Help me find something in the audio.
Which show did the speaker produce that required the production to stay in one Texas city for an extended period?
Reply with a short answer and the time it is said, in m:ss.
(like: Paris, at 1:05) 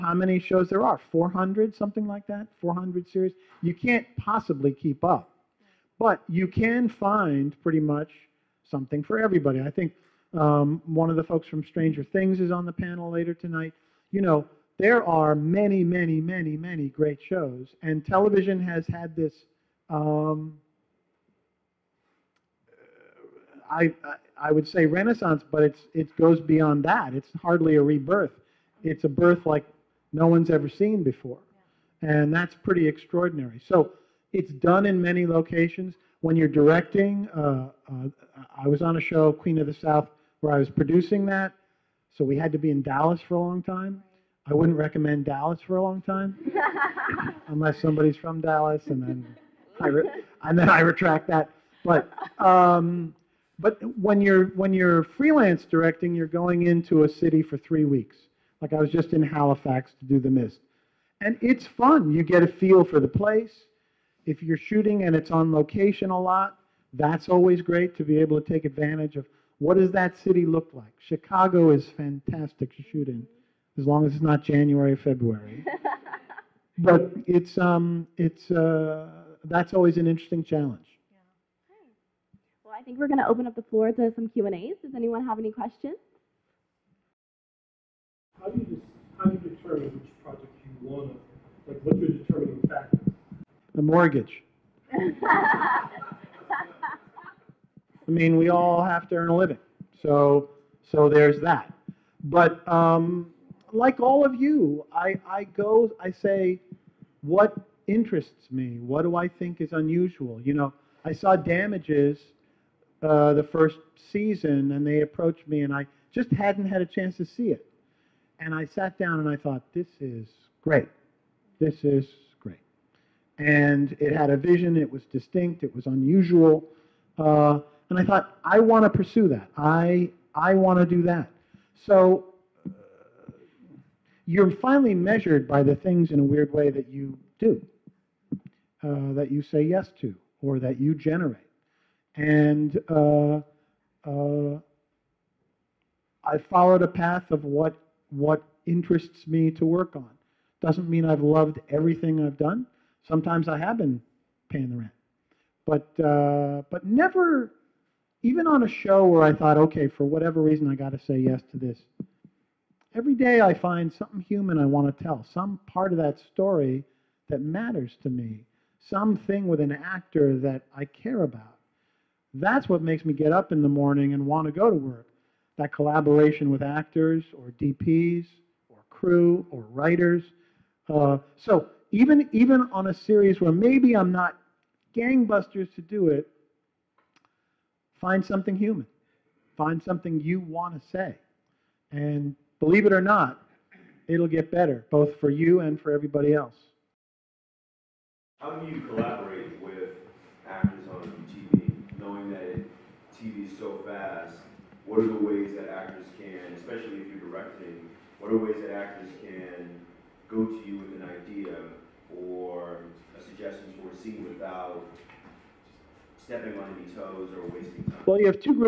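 Queen of the South, at 0:39.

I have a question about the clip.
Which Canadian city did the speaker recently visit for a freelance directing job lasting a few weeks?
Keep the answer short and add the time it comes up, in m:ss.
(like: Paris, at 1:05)
Halifax, at 0:59.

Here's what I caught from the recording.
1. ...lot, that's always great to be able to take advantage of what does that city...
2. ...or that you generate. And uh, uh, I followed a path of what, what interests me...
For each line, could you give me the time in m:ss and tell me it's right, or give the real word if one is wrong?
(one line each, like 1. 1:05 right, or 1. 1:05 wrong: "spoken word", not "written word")
1. 1:06 right
2. 2:20 right.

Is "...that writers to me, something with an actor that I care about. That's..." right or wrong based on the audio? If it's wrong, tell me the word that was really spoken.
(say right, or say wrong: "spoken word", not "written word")
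wrong: "matters", not "writers".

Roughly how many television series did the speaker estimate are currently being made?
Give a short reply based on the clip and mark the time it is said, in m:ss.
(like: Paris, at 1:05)
400, at 0:02.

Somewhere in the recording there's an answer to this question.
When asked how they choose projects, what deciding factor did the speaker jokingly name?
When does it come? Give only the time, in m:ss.
1:33.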